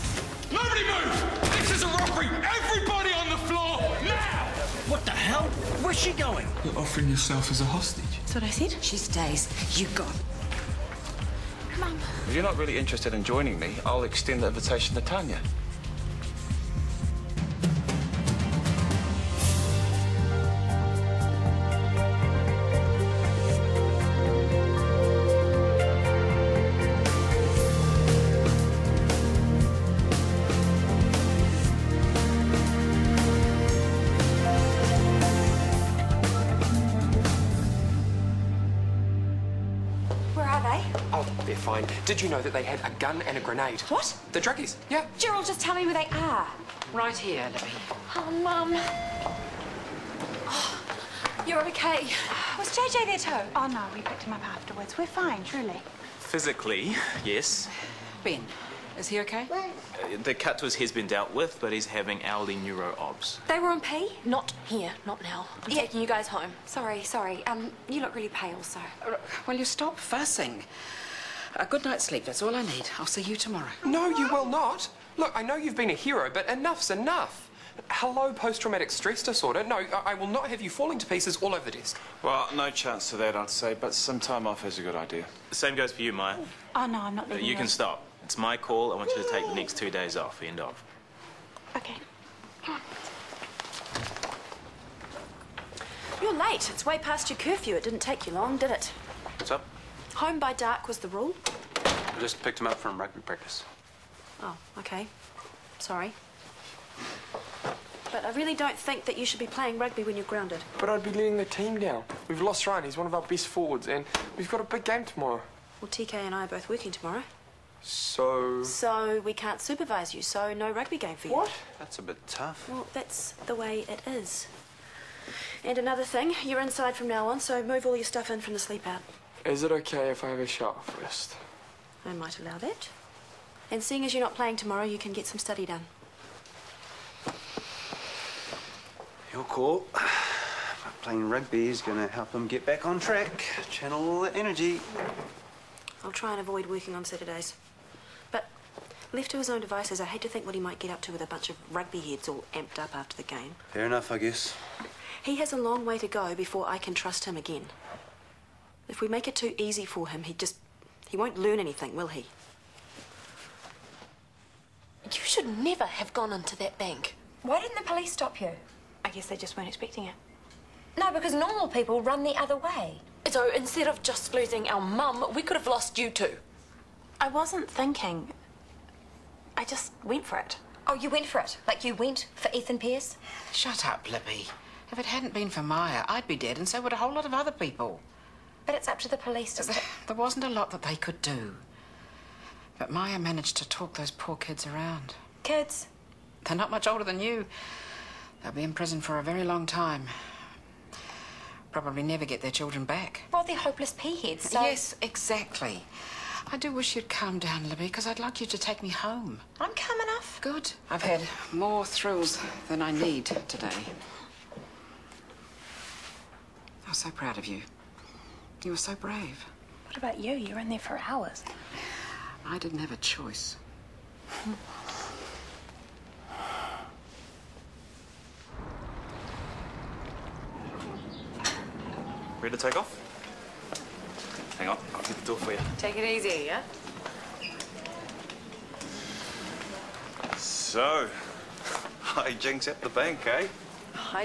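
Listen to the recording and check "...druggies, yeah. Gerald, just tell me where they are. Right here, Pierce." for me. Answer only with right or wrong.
wrong.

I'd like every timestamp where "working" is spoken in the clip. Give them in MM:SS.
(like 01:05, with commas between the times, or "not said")
01:56, 02:26.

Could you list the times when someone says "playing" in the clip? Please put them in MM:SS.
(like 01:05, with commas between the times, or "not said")
01:49, 02:14, 02:21.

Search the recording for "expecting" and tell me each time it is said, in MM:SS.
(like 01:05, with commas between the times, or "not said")
02:49.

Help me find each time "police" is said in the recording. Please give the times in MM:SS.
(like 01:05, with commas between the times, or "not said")
02:47, 03:09.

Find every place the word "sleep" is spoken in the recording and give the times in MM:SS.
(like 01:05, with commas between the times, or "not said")
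01:12, 02:08.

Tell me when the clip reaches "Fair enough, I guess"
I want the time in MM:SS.
02:33.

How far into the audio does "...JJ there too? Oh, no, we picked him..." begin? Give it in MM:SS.
00:52.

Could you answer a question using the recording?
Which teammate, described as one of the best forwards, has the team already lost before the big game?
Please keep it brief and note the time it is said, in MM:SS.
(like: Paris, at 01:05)
Ryan, at 01:52.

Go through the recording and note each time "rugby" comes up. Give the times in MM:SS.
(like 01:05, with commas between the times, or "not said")
01:42, 01:49, 02:00, 02:21, 02:31.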